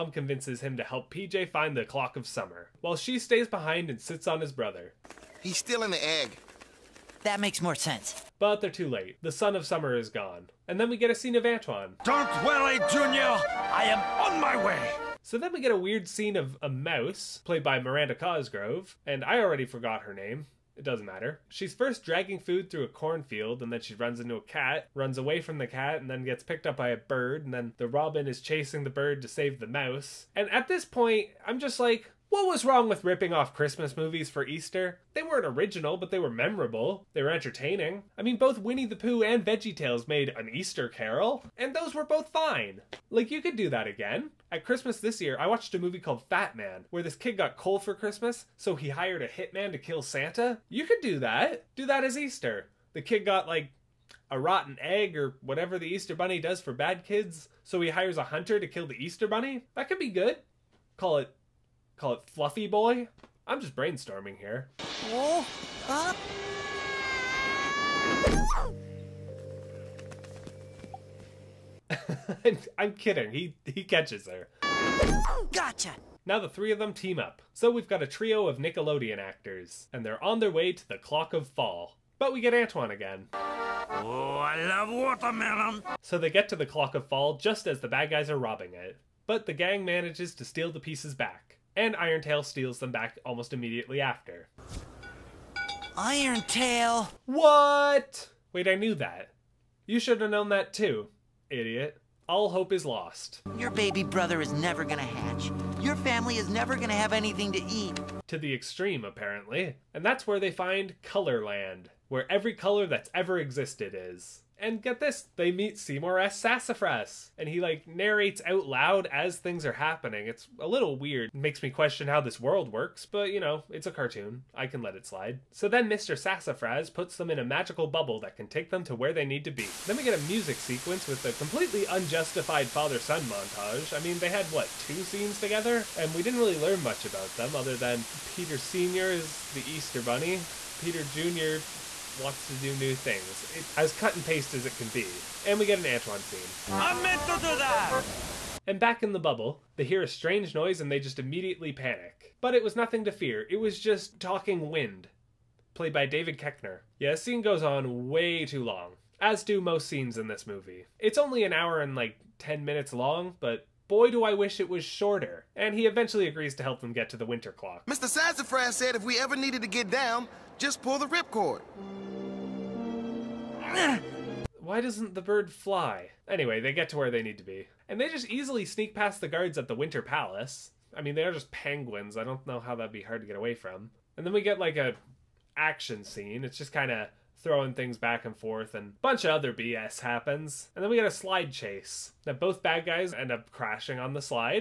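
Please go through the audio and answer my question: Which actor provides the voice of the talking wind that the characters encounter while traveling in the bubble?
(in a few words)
David Koechner.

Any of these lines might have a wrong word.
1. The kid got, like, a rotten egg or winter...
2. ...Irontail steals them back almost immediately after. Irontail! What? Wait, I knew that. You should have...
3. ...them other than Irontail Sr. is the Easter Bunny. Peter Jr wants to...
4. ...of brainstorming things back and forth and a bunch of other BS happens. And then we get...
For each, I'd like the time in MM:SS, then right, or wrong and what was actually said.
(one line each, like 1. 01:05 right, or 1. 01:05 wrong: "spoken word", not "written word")
1. 00:52 wrong: "whatever", not "winter"
2. 01:31 right
3. 02:17 wrong: "Peter", not "Irontail"
4. 03:06 wrong: "throwing", not "brainstorming".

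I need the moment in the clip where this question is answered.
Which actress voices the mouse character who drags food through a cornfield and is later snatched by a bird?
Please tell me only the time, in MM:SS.
00:17.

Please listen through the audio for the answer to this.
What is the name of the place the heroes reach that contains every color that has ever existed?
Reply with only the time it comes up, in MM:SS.
01:51.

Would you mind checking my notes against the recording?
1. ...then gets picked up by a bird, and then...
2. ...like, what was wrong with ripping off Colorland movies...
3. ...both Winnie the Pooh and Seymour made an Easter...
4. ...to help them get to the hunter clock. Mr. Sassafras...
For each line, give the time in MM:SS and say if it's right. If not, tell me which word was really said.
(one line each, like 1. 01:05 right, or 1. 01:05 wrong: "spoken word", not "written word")
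1. 00:26 right
2. 00:31 wrong: "Christmas", not "Colorland"
3. 00:38 wrong: "VeggieTales", not "Seymour"
4. 02:46 wrong: "winter", not "hunter".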